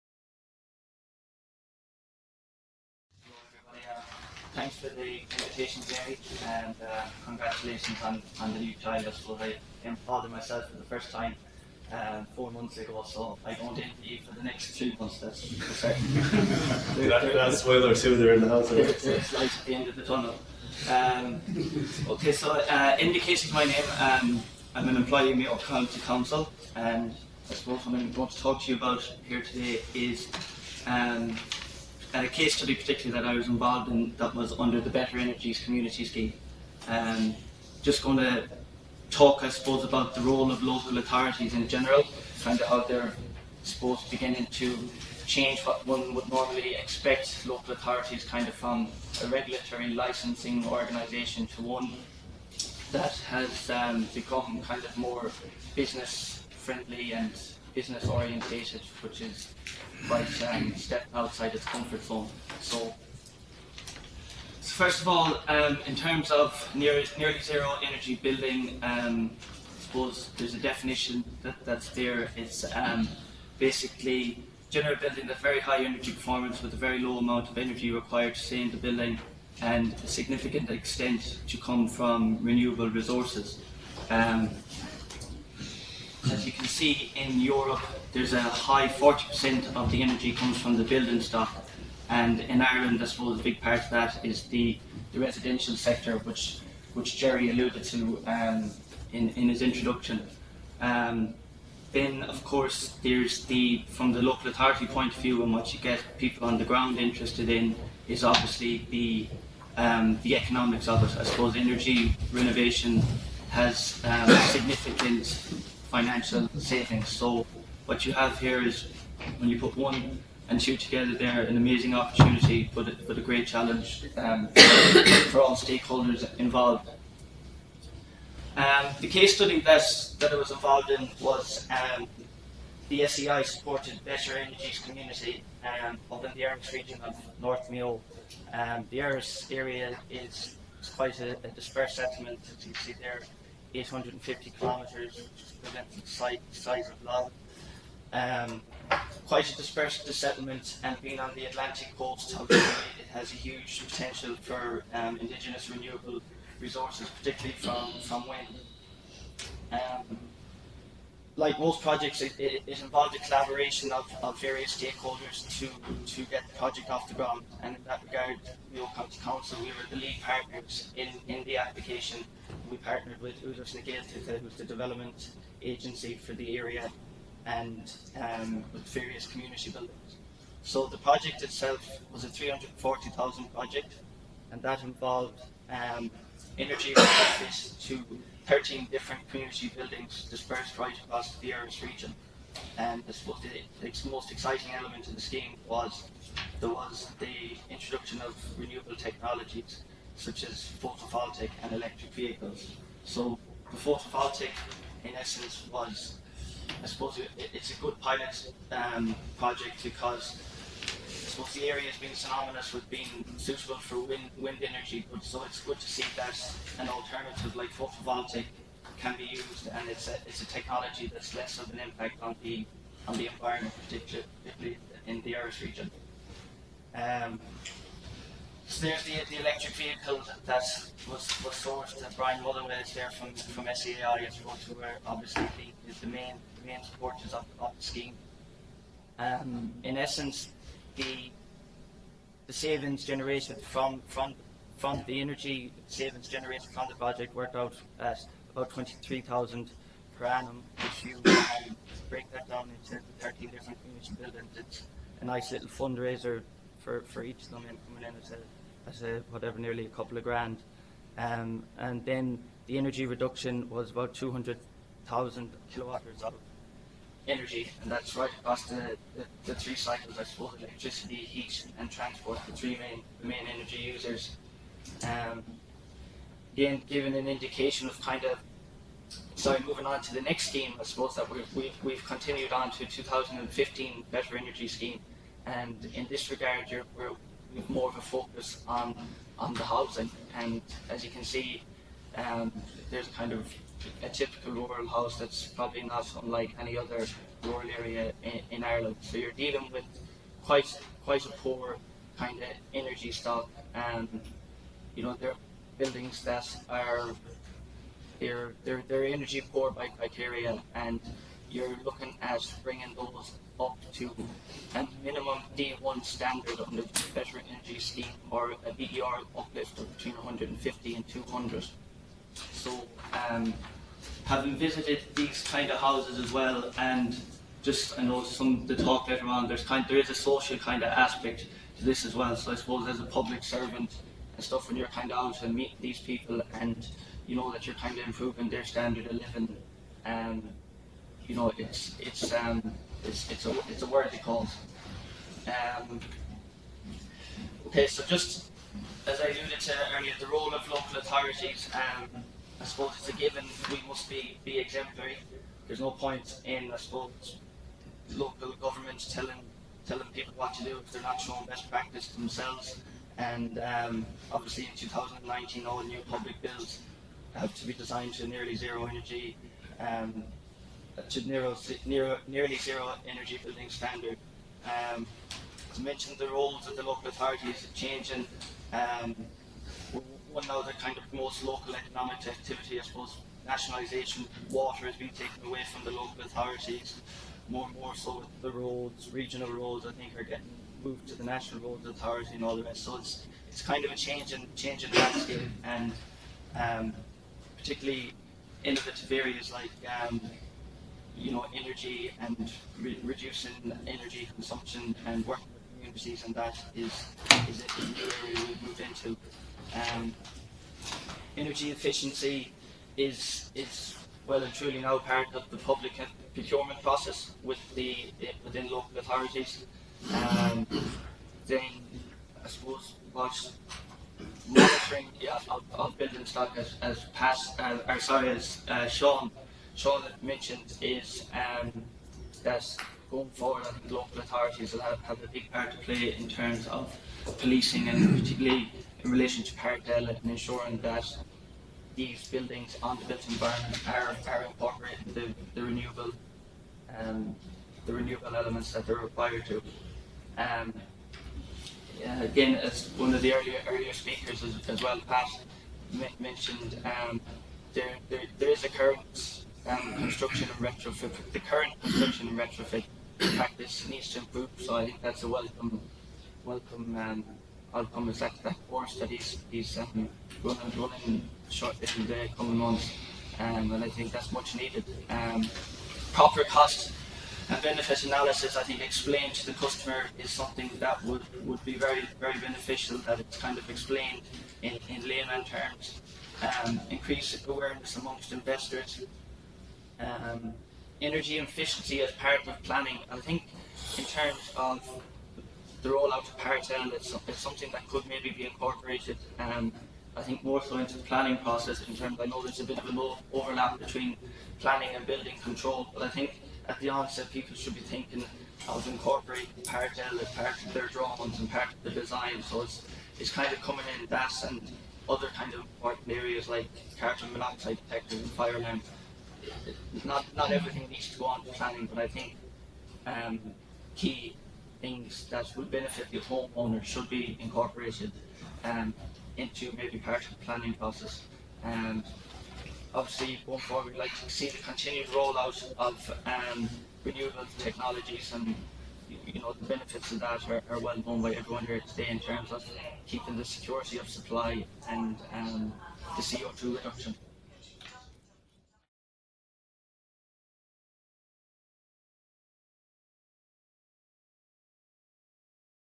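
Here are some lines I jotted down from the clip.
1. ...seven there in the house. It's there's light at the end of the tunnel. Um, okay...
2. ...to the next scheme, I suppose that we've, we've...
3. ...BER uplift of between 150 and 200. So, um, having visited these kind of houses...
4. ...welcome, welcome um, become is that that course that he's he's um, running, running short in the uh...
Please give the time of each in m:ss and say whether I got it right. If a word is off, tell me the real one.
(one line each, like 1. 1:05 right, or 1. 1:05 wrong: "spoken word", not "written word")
1. 0:18 wrong: "two", not "seven"
2. 4:40 right
3. 5:18 right
4. 7:45 wrong: "outcome", not "become".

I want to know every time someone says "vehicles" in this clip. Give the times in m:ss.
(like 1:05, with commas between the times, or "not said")
3:22, 3:49.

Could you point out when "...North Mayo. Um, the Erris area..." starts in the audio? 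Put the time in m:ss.
2:17.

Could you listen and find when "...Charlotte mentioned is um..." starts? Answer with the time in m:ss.
7:09.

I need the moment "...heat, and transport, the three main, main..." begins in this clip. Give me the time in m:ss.
4:31.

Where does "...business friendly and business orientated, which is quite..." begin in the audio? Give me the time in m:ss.
0:55.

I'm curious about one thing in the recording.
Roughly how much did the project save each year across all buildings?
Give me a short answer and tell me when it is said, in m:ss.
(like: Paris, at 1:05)
23,000 per annum, at 4:08.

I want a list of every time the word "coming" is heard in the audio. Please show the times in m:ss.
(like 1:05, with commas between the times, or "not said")
7:52, 8:33.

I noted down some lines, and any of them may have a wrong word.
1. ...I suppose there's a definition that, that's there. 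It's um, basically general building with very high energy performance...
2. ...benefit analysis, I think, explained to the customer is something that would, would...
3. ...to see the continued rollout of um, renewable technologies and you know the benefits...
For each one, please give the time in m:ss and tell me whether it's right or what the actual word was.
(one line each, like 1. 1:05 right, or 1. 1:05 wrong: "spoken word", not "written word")
1. 1:09 right
2. 7:57 right
3. 8:54 right.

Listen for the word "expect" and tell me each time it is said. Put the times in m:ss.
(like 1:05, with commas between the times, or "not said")
0:46.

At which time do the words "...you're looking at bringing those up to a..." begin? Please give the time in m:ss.
5:11.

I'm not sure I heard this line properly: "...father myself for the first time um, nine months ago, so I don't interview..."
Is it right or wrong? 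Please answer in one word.
wrong.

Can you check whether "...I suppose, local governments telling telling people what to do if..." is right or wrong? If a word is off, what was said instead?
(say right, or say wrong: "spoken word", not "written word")
right.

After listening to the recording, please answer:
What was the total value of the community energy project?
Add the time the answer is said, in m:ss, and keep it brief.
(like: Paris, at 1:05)
340,000, at 3:02.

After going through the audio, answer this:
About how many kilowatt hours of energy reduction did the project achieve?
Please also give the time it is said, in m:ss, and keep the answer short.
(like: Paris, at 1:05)
200,000, at 4:24.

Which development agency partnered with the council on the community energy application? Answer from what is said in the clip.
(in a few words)
Údarás na Gaeltachta.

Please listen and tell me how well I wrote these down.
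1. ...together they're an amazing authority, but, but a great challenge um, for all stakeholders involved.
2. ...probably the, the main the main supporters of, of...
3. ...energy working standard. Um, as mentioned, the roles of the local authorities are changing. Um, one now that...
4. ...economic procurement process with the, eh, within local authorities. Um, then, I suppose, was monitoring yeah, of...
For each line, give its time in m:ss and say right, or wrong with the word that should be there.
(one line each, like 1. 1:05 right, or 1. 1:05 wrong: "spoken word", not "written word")
1. 2:00 wrong: "opportunity", not "authority"
2. 3:55 wrong: "obviously", not "probably"
3. 6:13 wrong: "building", not "working"
4. 6:55 wrong: "public", not "economic".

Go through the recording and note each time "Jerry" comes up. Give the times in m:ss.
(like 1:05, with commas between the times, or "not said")
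0:05, 1:37.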